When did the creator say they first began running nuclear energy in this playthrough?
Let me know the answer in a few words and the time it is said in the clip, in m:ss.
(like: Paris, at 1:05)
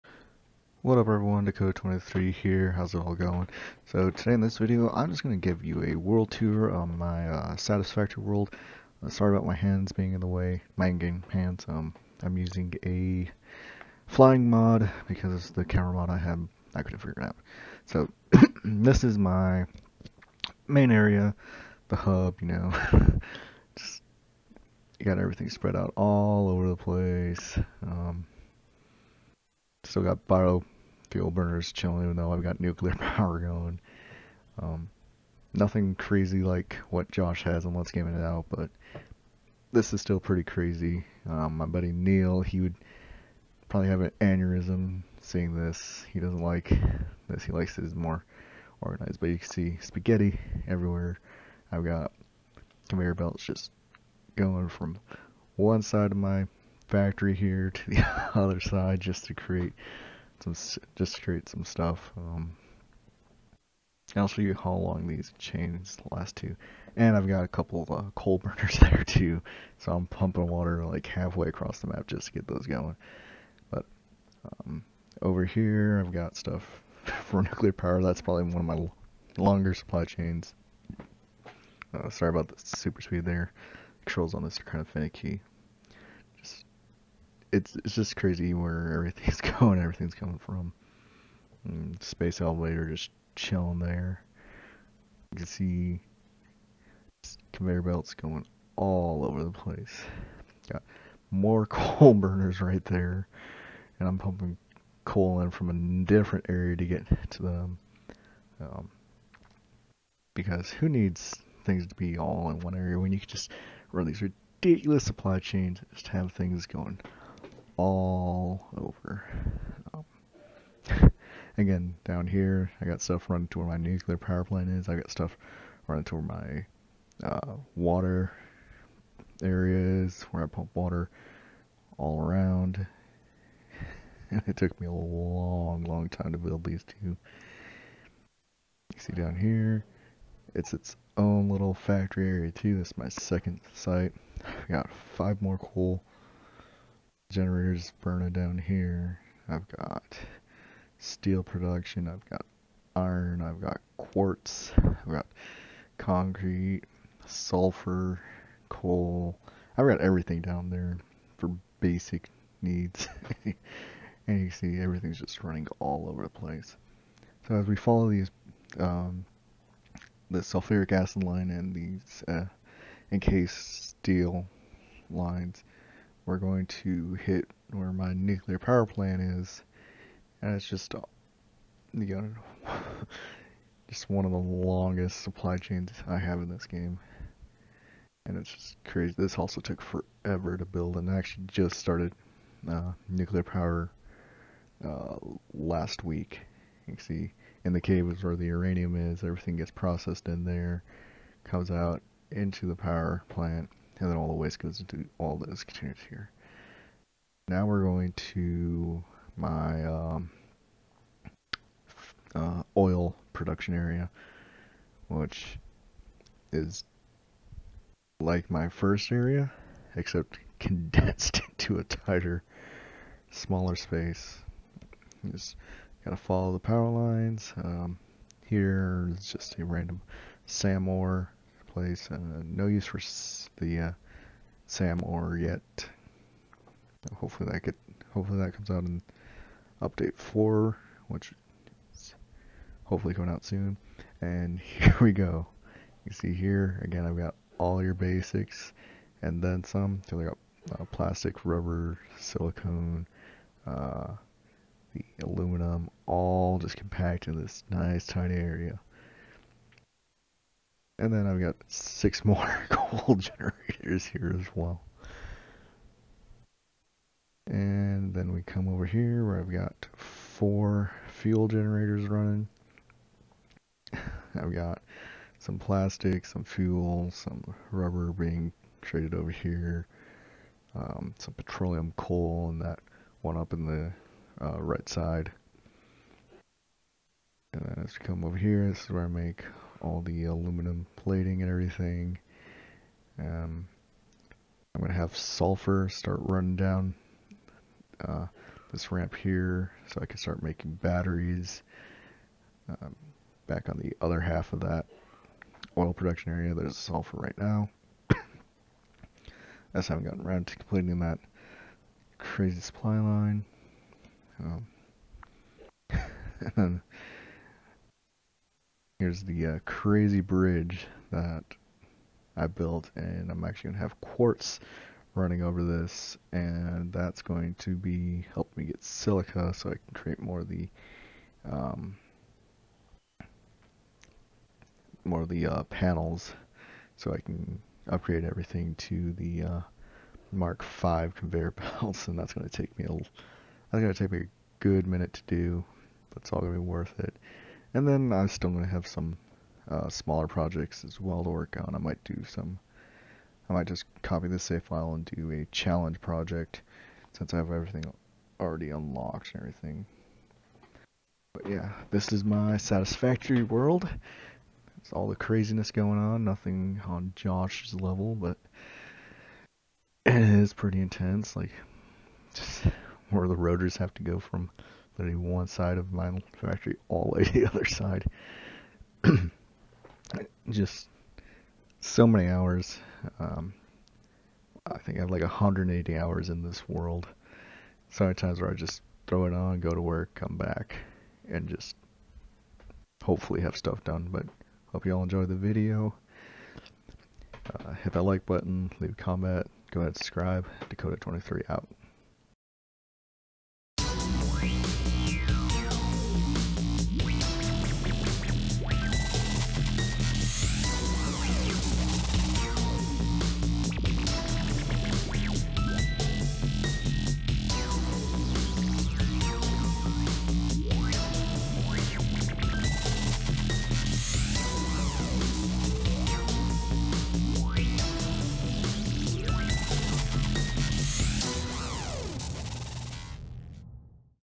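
Last week, at 3:15.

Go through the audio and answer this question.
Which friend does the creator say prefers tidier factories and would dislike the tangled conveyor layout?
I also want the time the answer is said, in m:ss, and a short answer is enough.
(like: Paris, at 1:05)
Neil, at 0:41.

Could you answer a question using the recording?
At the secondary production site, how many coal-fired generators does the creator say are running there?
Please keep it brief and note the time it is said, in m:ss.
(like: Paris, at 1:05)
5, at 2:25.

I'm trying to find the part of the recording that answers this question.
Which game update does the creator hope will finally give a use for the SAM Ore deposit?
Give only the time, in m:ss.
3:59.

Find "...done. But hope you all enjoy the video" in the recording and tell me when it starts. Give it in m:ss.
6:33.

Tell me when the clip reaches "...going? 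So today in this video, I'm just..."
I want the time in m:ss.
0:03.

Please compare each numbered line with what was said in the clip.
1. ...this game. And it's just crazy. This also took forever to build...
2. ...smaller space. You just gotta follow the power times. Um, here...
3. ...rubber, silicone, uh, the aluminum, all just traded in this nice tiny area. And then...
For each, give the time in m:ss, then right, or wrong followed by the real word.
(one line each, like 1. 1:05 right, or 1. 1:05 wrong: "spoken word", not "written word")
1. 3:06 right
2. 3:43 wrong: "lines", not "times"
3. 4:11 wrong: "compacted", not "traded".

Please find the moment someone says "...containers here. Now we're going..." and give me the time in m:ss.
3:25.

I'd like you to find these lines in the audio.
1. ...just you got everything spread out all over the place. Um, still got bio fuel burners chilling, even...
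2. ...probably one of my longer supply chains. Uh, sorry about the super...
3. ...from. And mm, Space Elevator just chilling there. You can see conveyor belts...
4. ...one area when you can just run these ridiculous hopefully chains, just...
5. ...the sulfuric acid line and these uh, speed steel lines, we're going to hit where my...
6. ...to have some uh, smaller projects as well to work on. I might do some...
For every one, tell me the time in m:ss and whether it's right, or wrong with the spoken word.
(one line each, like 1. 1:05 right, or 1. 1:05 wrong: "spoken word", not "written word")
1. 0:23 right
2. 1:18 right
3. 1:30 right
4. 1:52 wrong: "supply", not "hopefully"
5. 2:50 wrong: "encased", not "speed"
6. 5:48 right.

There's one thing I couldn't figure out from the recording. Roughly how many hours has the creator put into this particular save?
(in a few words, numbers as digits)
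180.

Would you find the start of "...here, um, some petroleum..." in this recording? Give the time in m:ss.
4:39.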